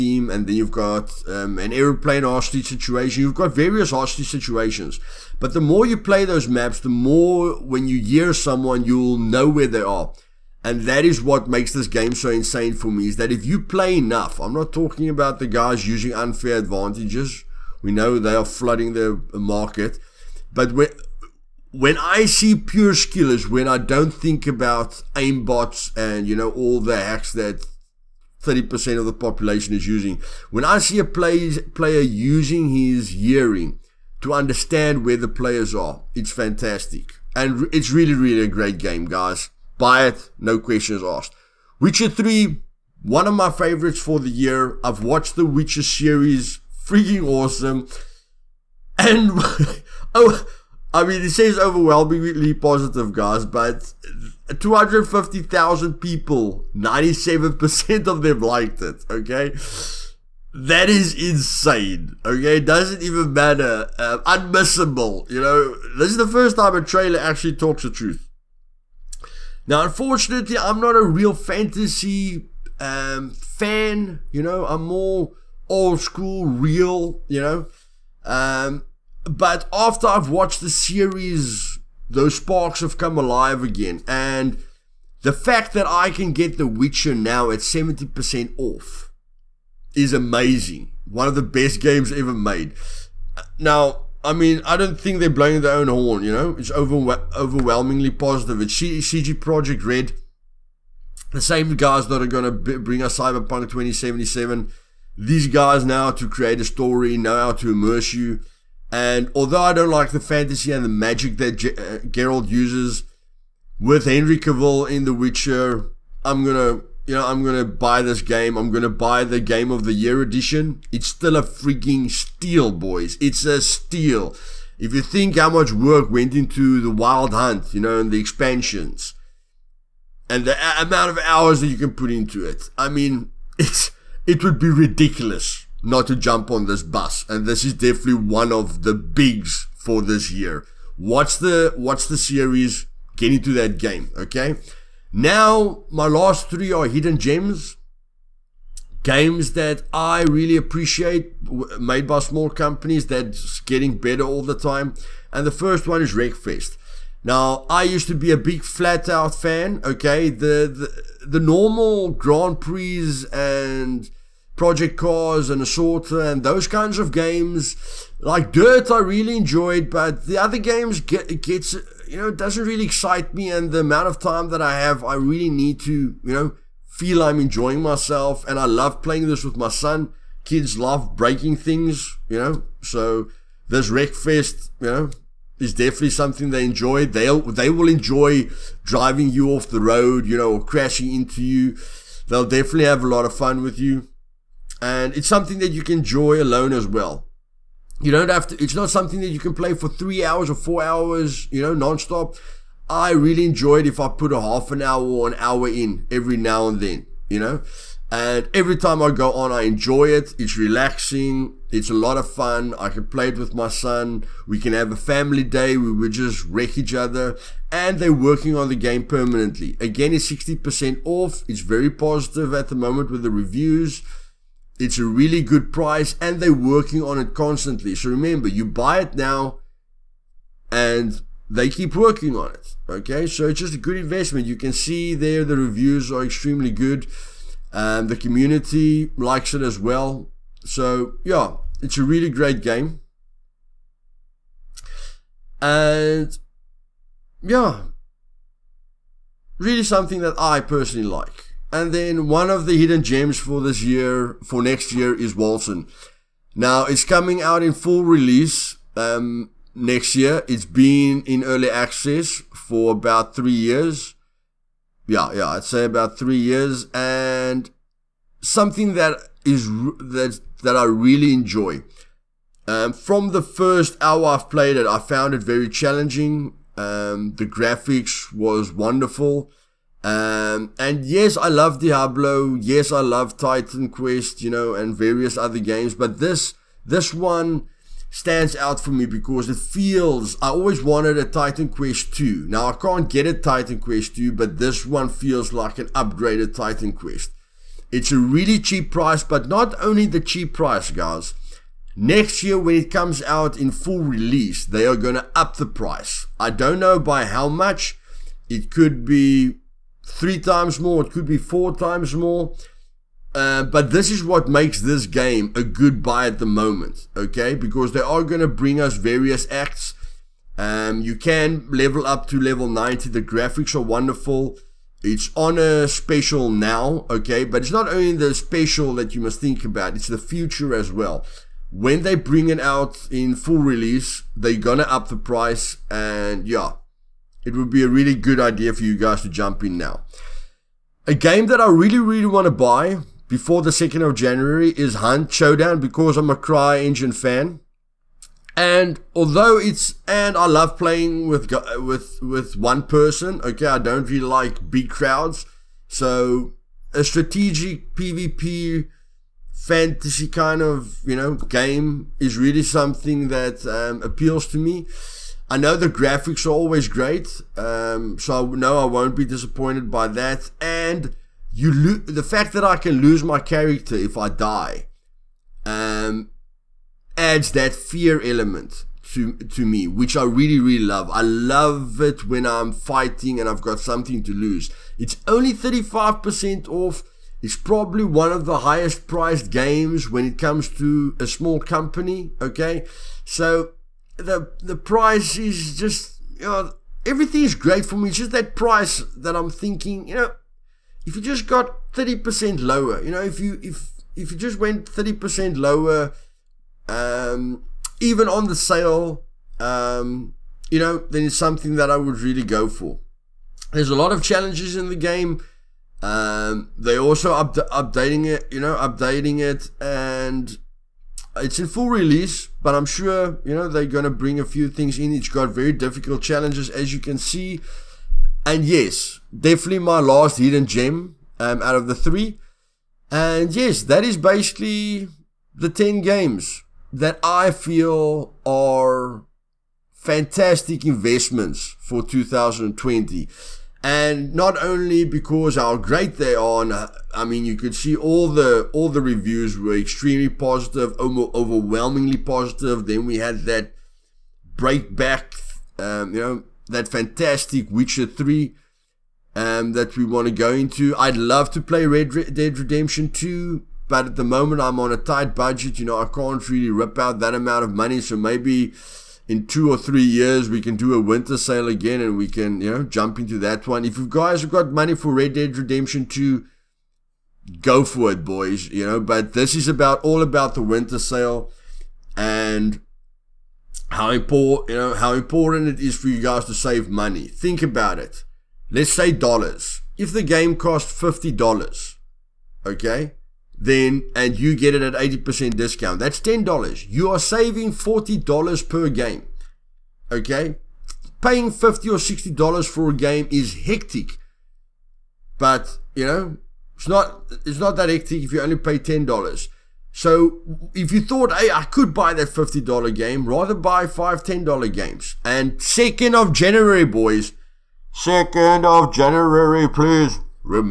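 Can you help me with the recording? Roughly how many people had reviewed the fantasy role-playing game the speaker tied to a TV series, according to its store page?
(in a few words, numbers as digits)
250,000.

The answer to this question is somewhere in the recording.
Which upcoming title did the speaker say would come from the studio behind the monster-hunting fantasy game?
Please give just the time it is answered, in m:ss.
1:43.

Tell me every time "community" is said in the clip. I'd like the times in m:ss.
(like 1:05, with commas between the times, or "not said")
3:58.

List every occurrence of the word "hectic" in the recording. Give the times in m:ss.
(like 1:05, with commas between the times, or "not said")
8:23, 8:27.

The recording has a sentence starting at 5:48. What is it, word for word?
And although it's and I love playing with with with one person, okay, I don't really like big crowds.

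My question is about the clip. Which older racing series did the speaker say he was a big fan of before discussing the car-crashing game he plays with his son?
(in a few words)
FlatOut.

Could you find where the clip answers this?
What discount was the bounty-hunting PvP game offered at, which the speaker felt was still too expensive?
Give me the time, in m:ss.
6:25.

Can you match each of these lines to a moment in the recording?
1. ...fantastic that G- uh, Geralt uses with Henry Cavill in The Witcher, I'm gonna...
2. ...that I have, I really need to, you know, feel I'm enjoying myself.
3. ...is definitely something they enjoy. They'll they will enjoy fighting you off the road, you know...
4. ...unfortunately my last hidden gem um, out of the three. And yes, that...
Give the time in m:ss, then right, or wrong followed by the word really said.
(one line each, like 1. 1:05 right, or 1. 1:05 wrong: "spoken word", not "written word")
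1. 1:50 wrong: "magic", not "fantastic"
2. 2:54 right
3. 3:05 wrong: "driving", not "fighting"
4. 7:09 wrong: "definitely", not "unfortunately".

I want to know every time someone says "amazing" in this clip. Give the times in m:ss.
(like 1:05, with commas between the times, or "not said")
1:30.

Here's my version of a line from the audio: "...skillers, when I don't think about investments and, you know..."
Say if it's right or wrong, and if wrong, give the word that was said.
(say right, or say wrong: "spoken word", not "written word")
wrong: "aimbots", not "investments".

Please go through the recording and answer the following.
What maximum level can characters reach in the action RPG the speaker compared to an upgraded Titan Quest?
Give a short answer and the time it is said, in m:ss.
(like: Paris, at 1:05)
90, at 5:22.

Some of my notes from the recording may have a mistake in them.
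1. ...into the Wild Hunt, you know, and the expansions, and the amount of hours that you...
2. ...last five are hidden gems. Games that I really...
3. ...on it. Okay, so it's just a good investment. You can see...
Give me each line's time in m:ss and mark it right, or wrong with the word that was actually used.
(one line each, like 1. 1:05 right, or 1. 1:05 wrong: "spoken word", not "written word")
1. 2:06 right
2. 2:26 wrong: "three", not "five"
3. 3:52 right.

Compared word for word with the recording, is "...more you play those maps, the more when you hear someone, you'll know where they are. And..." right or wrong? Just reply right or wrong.
right.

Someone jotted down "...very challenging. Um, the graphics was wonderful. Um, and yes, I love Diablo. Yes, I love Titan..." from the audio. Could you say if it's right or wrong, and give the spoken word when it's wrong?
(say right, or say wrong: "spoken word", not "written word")
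right.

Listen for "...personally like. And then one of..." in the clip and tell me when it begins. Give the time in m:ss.
4:10.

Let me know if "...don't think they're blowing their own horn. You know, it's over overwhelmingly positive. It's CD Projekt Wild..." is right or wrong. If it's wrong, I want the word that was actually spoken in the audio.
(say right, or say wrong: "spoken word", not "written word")
wrong: "Red", not "Wild".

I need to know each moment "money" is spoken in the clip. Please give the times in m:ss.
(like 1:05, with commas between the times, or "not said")
7:47, 7:54, 8:06.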